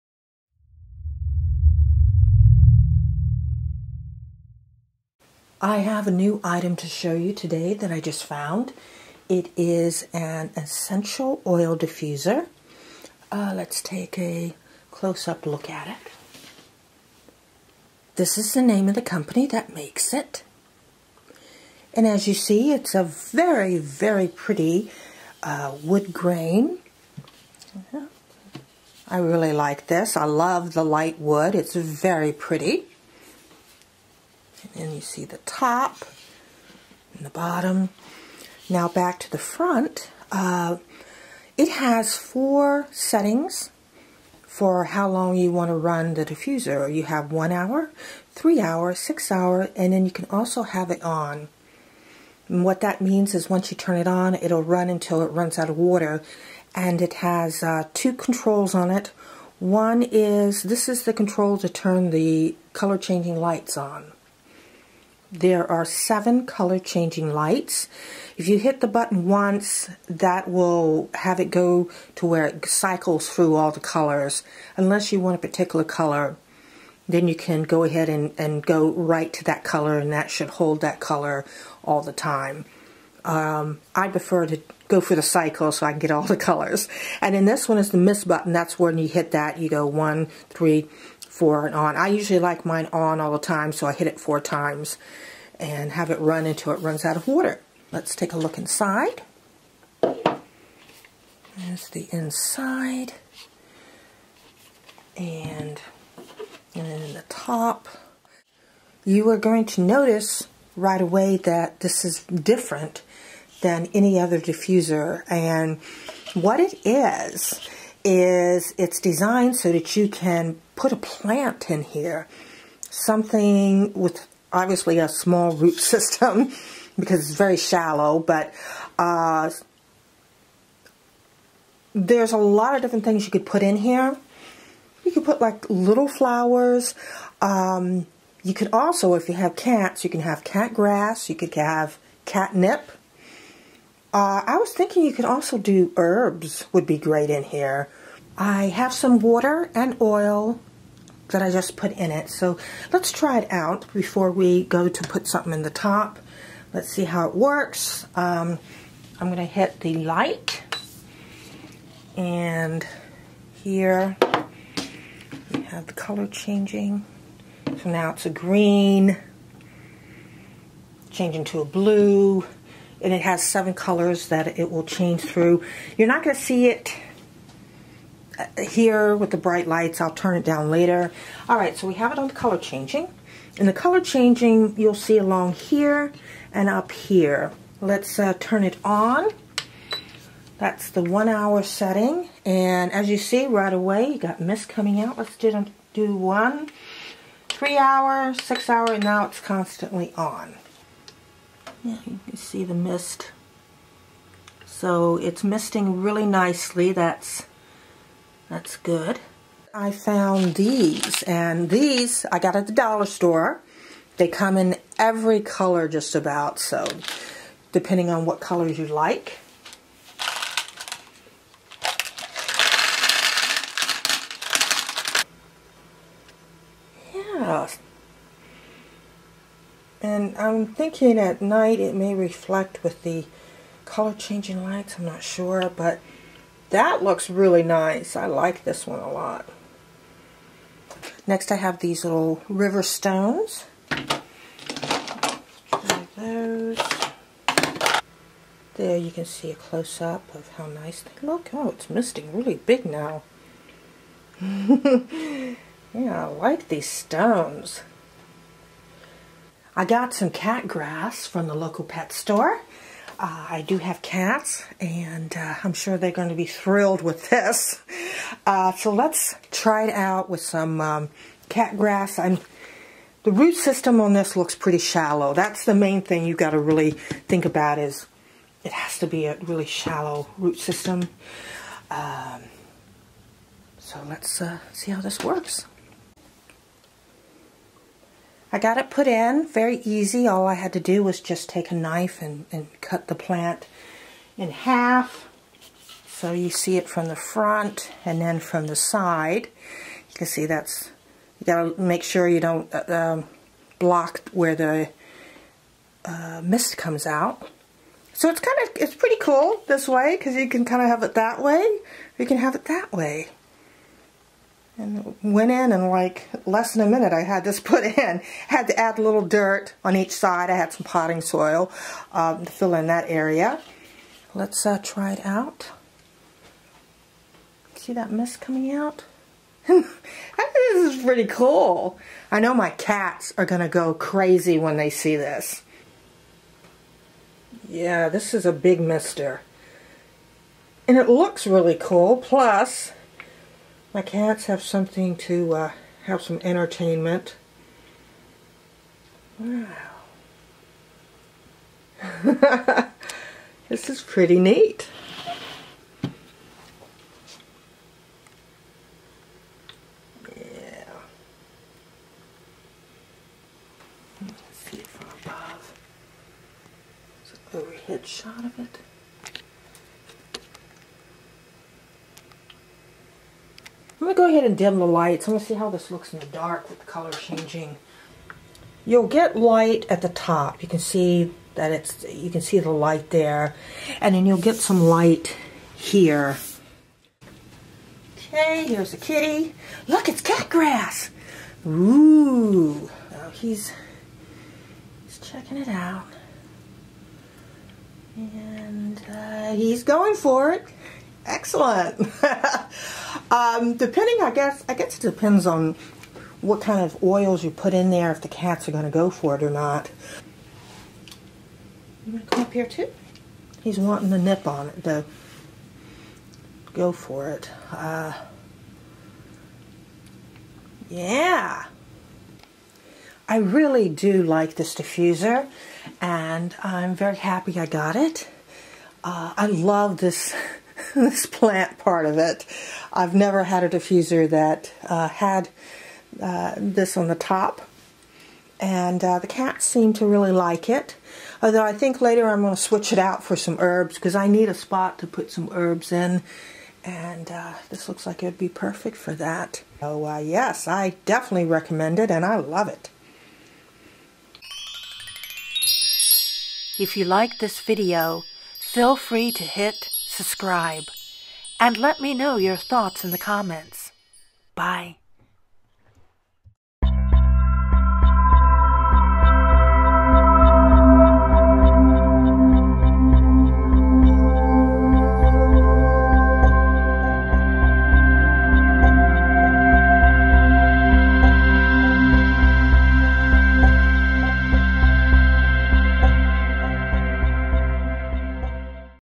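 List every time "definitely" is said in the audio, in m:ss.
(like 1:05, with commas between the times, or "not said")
7:31.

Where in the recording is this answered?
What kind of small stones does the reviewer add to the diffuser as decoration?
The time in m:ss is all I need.
4:02.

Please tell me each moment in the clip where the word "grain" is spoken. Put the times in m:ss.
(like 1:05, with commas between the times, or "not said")
0:26.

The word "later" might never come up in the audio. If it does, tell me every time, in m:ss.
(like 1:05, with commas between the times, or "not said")
3:00, 7:21.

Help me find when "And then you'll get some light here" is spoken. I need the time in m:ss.
6:24.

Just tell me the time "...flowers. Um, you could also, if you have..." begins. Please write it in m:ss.
2:16.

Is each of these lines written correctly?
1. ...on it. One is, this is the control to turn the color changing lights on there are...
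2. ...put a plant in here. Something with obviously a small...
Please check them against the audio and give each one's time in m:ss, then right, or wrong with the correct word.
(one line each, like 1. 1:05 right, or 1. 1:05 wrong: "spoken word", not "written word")
1. 0:58 right
2. 2:00 right.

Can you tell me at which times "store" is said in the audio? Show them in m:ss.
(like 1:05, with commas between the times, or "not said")
3:33, 4:22.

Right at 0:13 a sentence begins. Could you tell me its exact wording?
Uh, let's take a close-up look at it.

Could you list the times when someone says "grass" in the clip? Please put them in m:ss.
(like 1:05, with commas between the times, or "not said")
2:20, 4:20, 4:31, 6:30.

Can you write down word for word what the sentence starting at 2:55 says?
You're not going to see it here with the bright lights.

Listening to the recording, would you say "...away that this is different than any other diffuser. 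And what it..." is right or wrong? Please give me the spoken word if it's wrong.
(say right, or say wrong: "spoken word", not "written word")
right.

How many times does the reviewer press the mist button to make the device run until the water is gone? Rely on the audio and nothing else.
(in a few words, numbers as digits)
4.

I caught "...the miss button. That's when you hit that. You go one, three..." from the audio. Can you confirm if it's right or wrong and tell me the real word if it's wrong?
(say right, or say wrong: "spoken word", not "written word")
right.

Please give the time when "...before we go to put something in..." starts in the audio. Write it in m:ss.
2:33.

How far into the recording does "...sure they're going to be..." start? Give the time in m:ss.
4:25.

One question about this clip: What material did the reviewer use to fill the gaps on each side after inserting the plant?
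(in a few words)
potting soil.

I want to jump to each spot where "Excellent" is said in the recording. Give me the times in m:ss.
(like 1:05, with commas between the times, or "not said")
6:41.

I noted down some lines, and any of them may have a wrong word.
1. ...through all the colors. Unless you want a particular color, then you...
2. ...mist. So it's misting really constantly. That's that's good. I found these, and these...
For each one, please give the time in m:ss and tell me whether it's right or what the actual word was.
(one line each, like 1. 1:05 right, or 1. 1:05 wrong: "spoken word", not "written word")
1. 1:13 right
2. 3:22 wrong: "nicely", not "constantly".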